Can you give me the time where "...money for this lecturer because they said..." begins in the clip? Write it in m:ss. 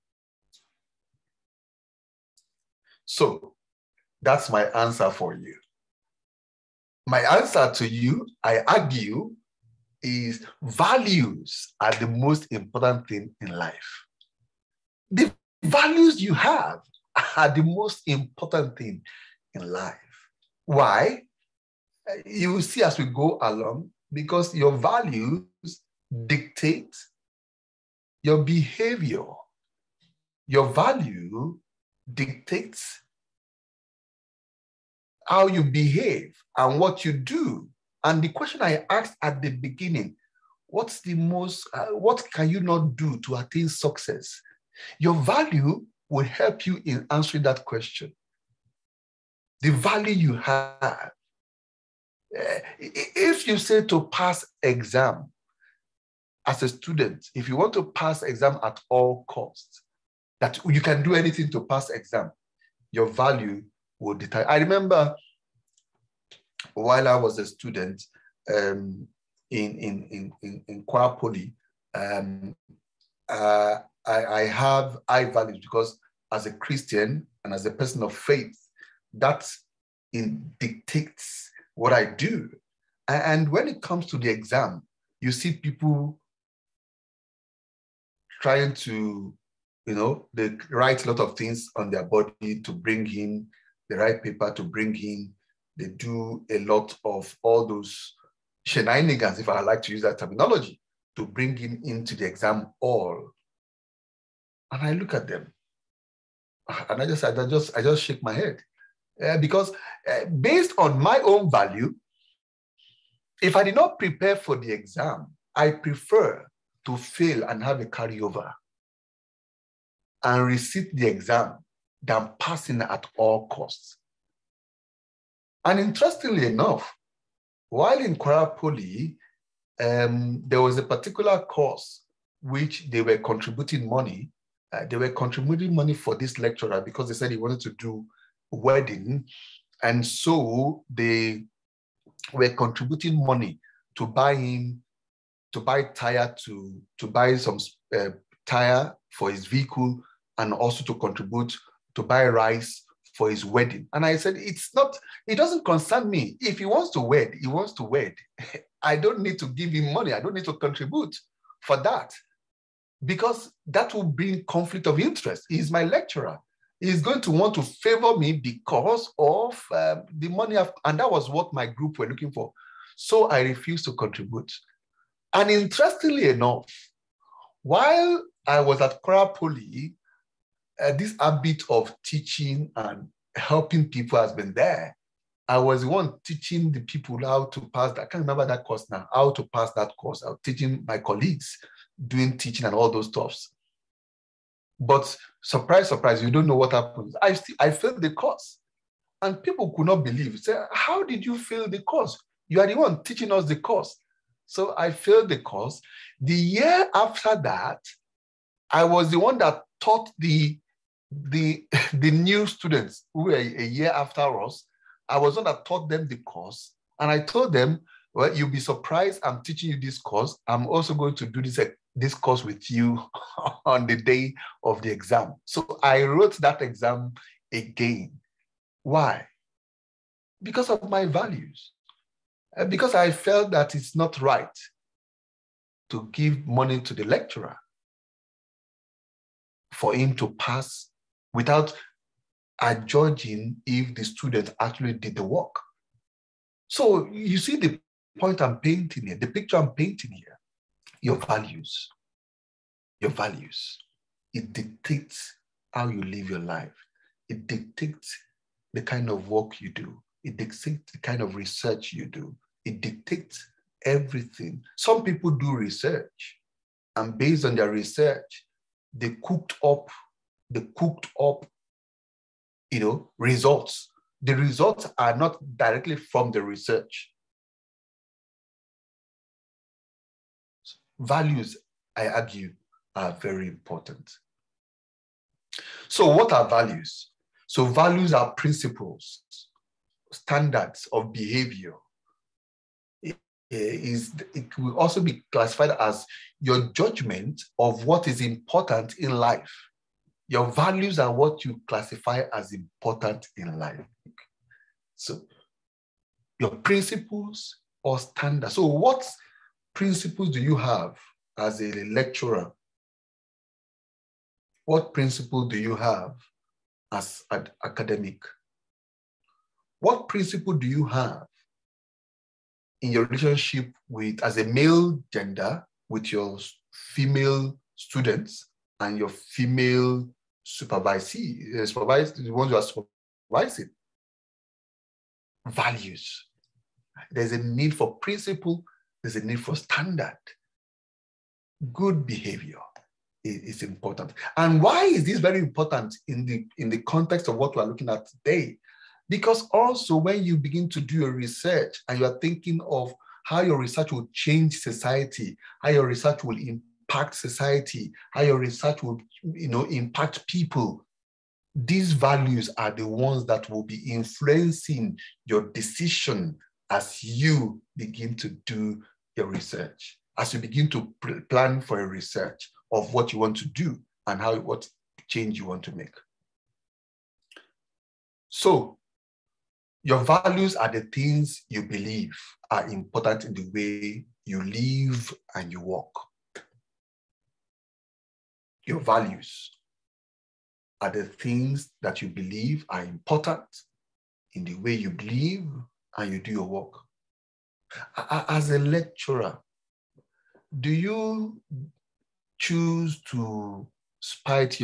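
2:15.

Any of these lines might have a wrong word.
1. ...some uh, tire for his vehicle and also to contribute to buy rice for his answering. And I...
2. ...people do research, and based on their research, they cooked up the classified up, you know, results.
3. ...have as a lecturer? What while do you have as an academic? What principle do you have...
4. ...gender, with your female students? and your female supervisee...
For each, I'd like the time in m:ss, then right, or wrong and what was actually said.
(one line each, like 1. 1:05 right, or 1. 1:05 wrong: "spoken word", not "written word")
1. 2:27 wrong: "wedding", not "answering"
2. 4:25 wrong: "cooked", not "classified"
3. 5:10 wrong: "principle", not "while"
4. 5:25 right.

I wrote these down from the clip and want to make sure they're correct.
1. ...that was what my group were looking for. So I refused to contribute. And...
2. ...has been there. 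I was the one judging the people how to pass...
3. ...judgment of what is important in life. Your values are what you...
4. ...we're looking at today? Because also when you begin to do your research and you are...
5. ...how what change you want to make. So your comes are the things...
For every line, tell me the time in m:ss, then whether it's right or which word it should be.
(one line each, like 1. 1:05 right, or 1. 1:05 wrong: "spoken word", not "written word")
1. 2:50 right
2. 3:04 wrong: "teaching", not "judging"
3. 4:56 right
4. 5:47 right
5. 6:14 wrong: "values", not "comes".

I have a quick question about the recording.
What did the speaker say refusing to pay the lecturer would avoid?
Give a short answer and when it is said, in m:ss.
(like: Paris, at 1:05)
Conflict of interest, at 2:44.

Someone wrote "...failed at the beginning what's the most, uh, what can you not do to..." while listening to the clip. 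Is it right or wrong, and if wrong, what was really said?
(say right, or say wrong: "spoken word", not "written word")
wrong: "asked", not "failed".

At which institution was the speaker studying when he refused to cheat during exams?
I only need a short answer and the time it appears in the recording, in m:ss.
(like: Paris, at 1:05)
Kwa Poly, at 1:10.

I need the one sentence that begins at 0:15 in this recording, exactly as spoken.
The values you have are the most important thing in life.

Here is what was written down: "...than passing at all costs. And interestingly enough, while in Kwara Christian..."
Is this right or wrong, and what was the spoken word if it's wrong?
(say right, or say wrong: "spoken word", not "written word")
wrong: "Poly", not "Christian".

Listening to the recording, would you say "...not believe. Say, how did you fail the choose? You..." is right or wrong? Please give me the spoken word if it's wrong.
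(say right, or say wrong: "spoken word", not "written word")
wrong: "course", not "choose".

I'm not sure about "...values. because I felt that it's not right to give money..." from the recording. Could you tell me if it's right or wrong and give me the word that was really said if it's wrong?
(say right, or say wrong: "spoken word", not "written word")
right.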